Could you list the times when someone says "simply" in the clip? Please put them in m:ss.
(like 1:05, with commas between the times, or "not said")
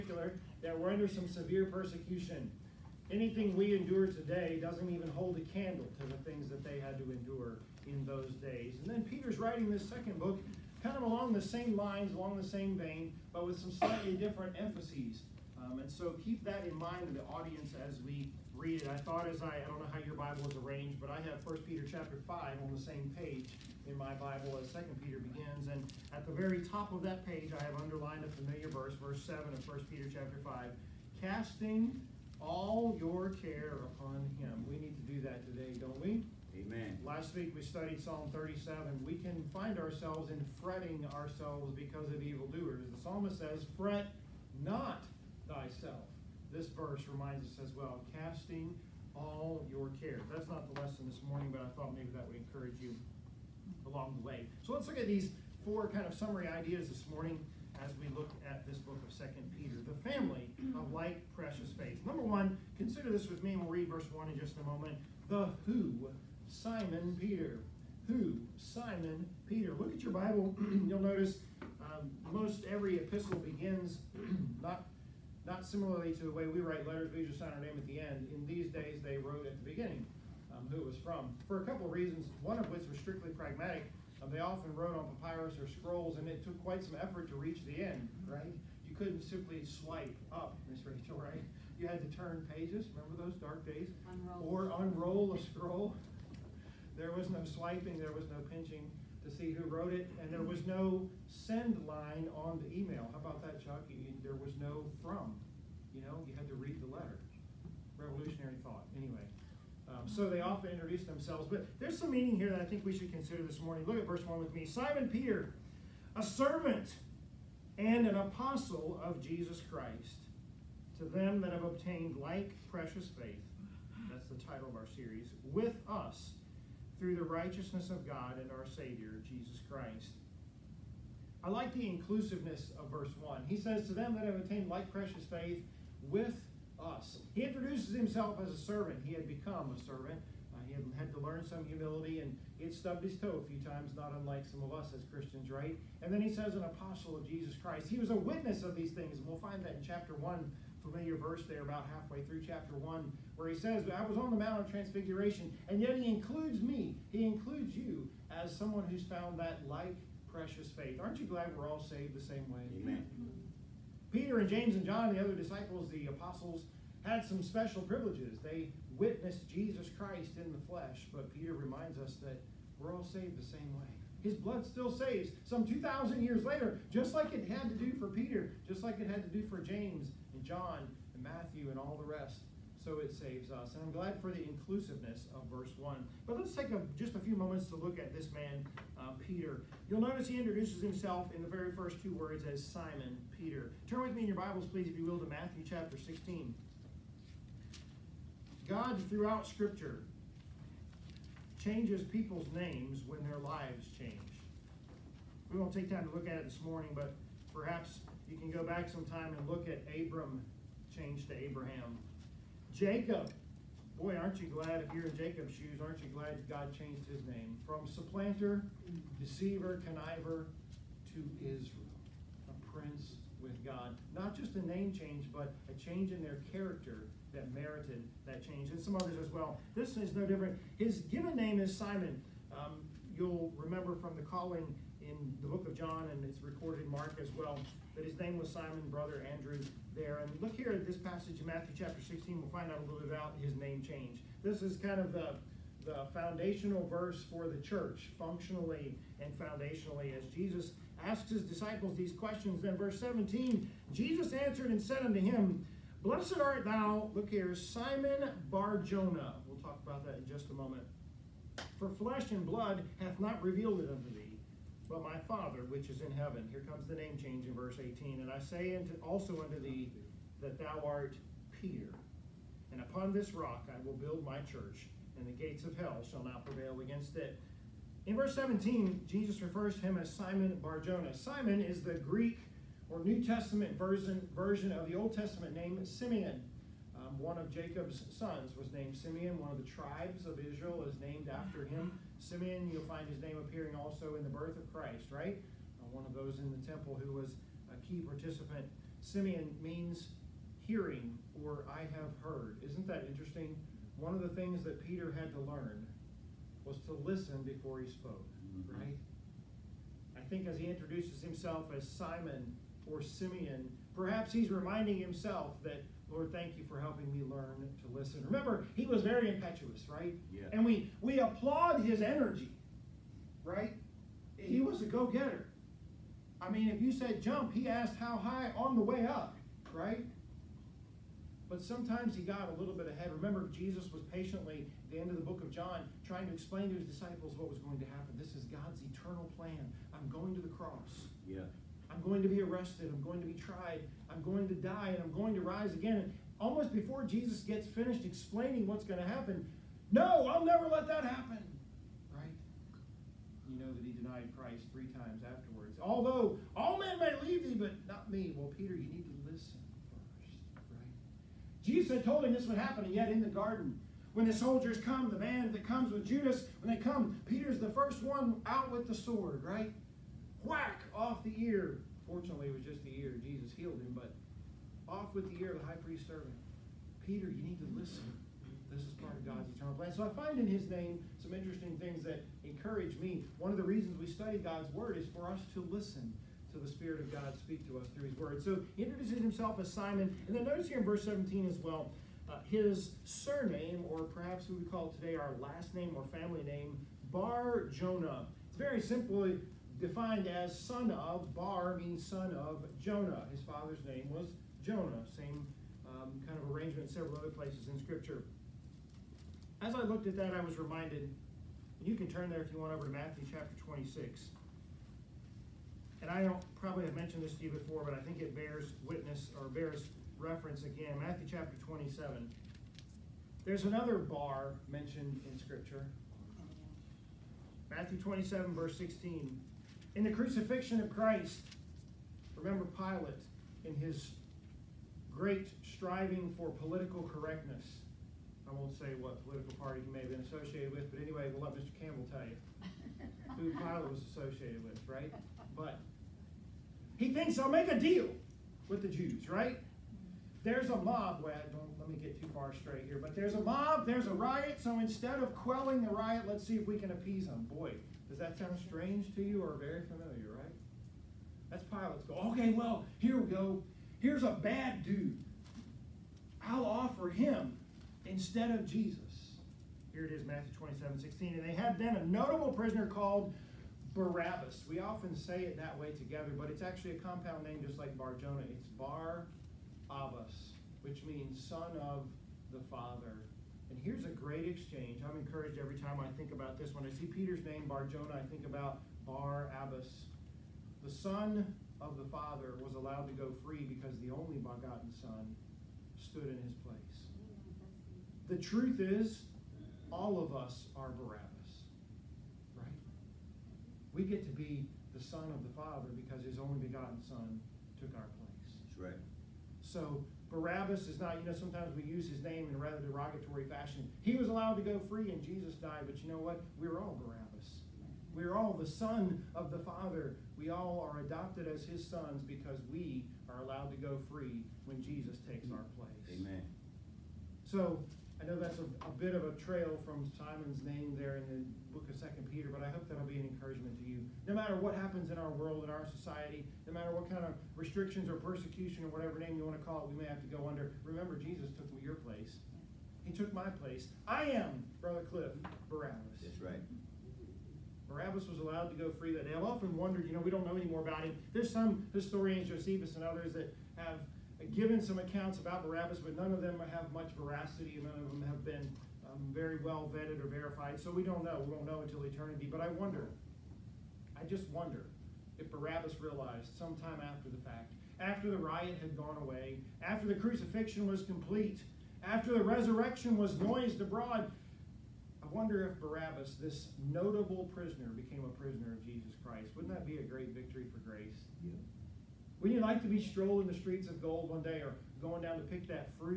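1:29, 6:38.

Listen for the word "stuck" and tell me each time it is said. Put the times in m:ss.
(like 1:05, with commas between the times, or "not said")
not said.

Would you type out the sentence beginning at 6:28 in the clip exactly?
So he introduces himself as Simon.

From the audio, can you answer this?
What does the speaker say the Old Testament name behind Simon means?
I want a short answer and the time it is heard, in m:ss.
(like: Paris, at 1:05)
hearing, at 5:00.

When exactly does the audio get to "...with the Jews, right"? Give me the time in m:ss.
7:28.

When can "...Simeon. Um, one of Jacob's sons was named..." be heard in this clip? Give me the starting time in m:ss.
4:45.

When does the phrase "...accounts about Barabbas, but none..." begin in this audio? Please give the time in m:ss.
9:14.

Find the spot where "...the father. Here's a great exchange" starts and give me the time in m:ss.
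8:02.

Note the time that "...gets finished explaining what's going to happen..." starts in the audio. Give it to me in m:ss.
5:47.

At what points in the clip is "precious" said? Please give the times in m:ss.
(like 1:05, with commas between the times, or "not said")
1:01, 2:02, 2:14, 2:40.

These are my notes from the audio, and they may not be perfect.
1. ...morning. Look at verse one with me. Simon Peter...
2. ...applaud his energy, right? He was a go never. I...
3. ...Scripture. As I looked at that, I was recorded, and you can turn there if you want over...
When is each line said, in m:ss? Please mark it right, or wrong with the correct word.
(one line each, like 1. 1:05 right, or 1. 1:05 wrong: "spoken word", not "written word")
1. 1:53 right
2. 5:21 wrong: "getter", not "never"
3. 6:47 wrong: "reminded", not "recorded".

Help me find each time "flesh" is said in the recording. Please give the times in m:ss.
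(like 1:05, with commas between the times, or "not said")
2:50, 4:21.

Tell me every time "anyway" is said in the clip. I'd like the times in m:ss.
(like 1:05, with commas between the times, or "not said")
1:48, 7:21.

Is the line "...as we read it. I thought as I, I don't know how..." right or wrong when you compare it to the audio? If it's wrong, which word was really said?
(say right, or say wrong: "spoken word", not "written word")
right.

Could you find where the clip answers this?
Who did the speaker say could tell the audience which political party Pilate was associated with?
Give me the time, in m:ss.
7:21.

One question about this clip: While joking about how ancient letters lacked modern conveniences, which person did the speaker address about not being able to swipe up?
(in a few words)
Miss Rachel.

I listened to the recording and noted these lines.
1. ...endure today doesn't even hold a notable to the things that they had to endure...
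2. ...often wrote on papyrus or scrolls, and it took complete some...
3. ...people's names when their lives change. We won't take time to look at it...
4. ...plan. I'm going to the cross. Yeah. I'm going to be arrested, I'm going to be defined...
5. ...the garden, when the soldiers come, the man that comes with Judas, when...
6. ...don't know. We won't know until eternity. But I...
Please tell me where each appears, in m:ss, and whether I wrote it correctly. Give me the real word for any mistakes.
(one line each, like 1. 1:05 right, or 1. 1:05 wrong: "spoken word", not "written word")
1. 0:03 wrong: "candle", not "notable"
2. 1:24 wrong: "quite", not "complete"
3. 3:22 right
4. 5:39 wrong: "tried", not "defined"
5. 6:03 right
6. 9:21 right.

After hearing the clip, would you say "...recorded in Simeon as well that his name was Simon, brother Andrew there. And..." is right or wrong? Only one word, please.
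wrong.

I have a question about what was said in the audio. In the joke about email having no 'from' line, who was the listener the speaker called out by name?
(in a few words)
Chuck.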